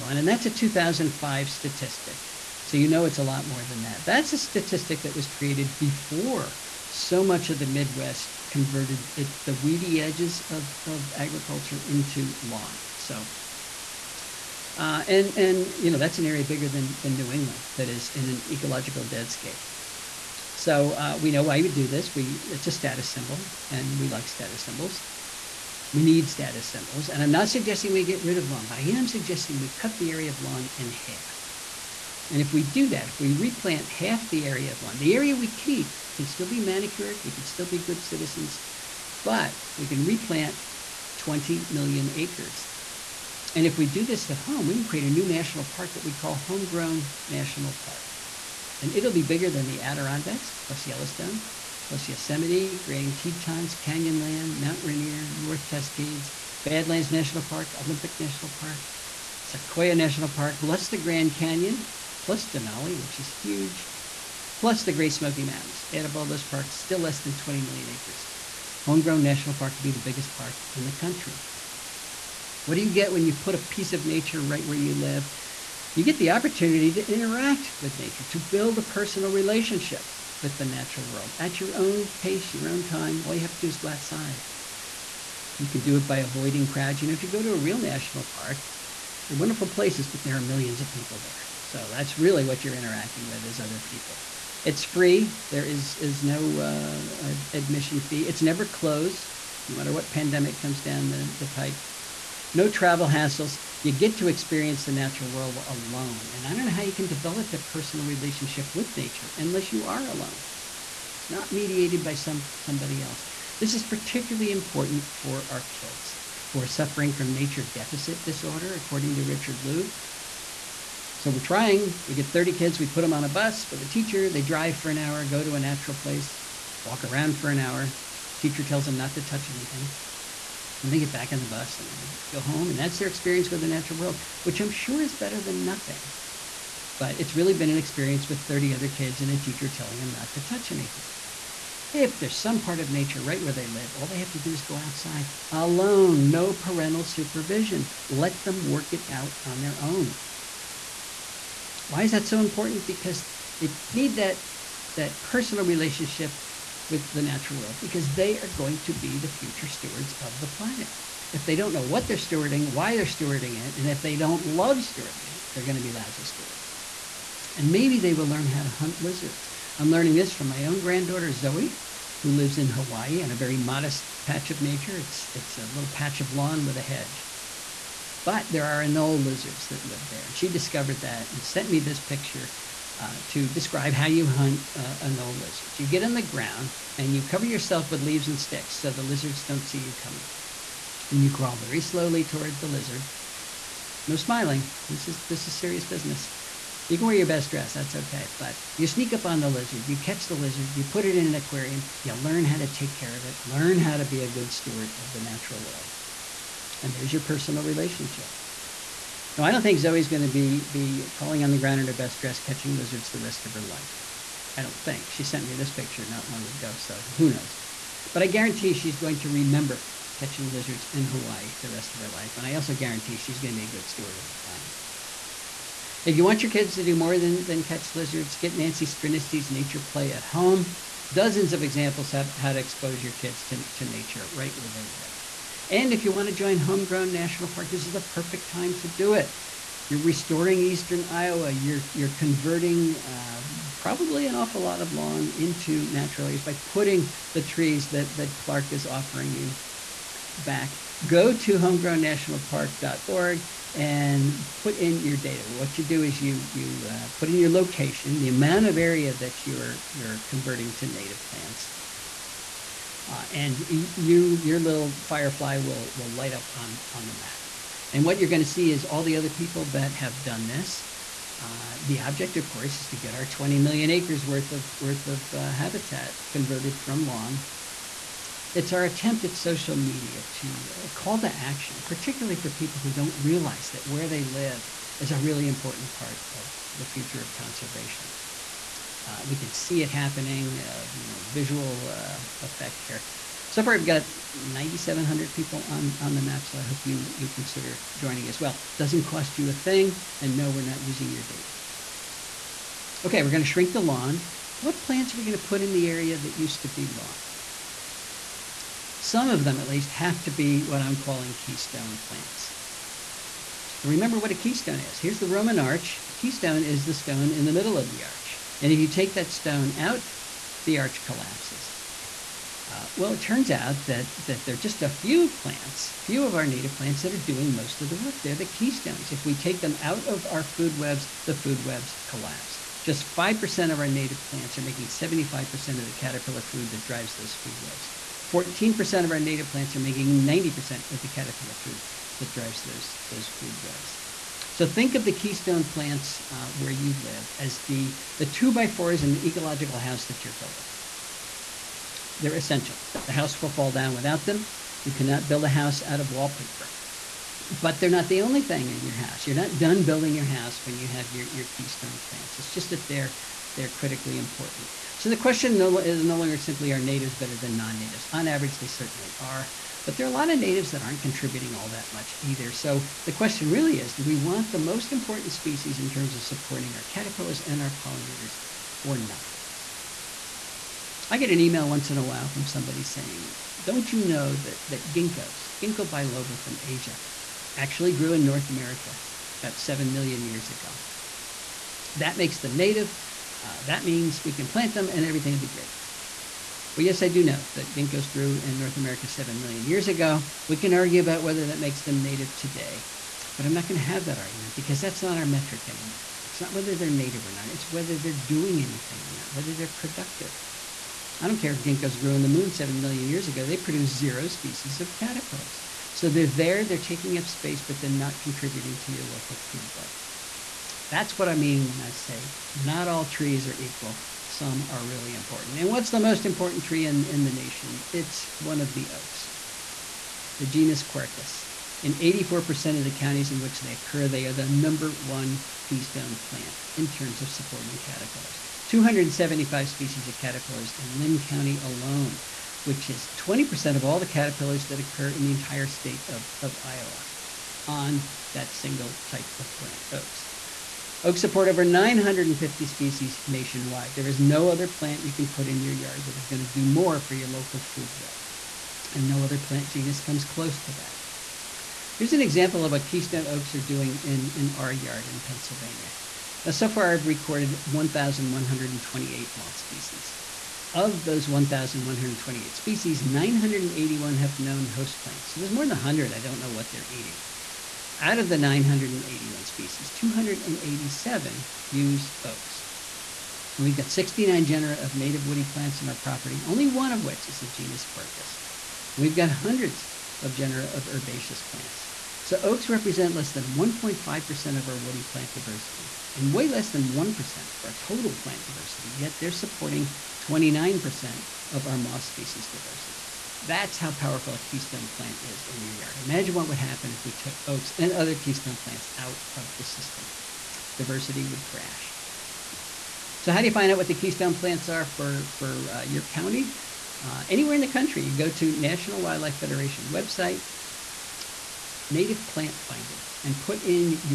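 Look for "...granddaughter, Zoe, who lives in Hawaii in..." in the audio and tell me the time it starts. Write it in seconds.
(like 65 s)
170 s.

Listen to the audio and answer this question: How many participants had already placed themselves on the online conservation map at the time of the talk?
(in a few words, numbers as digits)
9,700.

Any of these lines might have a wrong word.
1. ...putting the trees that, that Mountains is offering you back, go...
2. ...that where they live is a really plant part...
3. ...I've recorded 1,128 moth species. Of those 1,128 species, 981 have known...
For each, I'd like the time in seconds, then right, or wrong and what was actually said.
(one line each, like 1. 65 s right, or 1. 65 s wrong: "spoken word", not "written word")
1. 246 s wrong: "Clark", not "Mountains"
2. 283 s wrong: "important", not "plant"
3. 466 s right.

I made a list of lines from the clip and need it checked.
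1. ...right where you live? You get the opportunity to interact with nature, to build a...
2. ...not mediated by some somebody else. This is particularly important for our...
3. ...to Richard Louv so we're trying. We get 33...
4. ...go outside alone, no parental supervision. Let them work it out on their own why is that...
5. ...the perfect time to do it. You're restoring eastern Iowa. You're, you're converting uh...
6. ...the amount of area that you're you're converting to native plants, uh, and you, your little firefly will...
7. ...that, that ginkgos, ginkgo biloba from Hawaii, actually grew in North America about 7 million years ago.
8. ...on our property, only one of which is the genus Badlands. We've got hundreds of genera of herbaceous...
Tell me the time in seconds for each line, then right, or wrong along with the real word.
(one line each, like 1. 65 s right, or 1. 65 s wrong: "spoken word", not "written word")
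1. 74 s right
2. 111 s right
3. 119 s wrong: "30", not "33"
4. 144 s right
5. 237 s right
6. 258 s right
7. 384 s wrong: "Asia", not "Hawaii"
8. 485 s wrong: "Quercus", not "Badlands".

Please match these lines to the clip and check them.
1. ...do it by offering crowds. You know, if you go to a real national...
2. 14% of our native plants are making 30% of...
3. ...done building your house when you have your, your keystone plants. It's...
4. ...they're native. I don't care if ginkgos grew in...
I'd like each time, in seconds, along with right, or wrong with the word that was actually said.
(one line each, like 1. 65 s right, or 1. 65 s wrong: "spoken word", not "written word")
1. 85 s wrong: "avoiding", not "offering"
2. 338 s wrong: "90", not "30"
3. 359 s right
4. 409 s wrong: "productive", not "native".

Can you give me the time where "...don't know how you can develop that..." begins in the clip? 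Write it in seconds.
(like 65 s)
106 s.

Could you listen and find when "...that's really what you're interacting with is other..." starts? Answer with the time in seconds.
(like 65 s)
91 s.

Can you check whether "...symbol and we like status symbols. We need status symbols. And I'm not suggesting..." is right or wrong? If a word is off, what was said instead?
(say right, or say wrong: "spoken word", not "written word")
right.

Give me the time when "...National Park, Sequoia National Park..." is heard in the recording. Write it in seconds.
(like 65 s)
58 s.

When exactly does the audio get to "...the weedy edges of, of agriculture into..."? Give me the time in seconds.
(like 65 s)
9 s.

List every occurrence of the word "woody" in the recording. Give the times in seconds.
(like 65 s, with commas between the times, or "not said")
485 s, 494 s.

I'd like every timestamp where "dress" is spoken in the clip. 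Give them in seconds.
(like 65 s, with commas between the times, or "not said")
197 s, 212 s.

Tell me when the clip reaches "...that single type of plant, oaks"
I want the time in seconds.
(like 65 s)
448 s.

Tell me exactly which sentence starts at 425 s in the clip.
And what's the most important tree in, in the nation?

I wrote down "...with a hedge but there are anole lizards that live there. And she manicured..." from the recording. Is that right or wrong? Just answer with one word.
wrong.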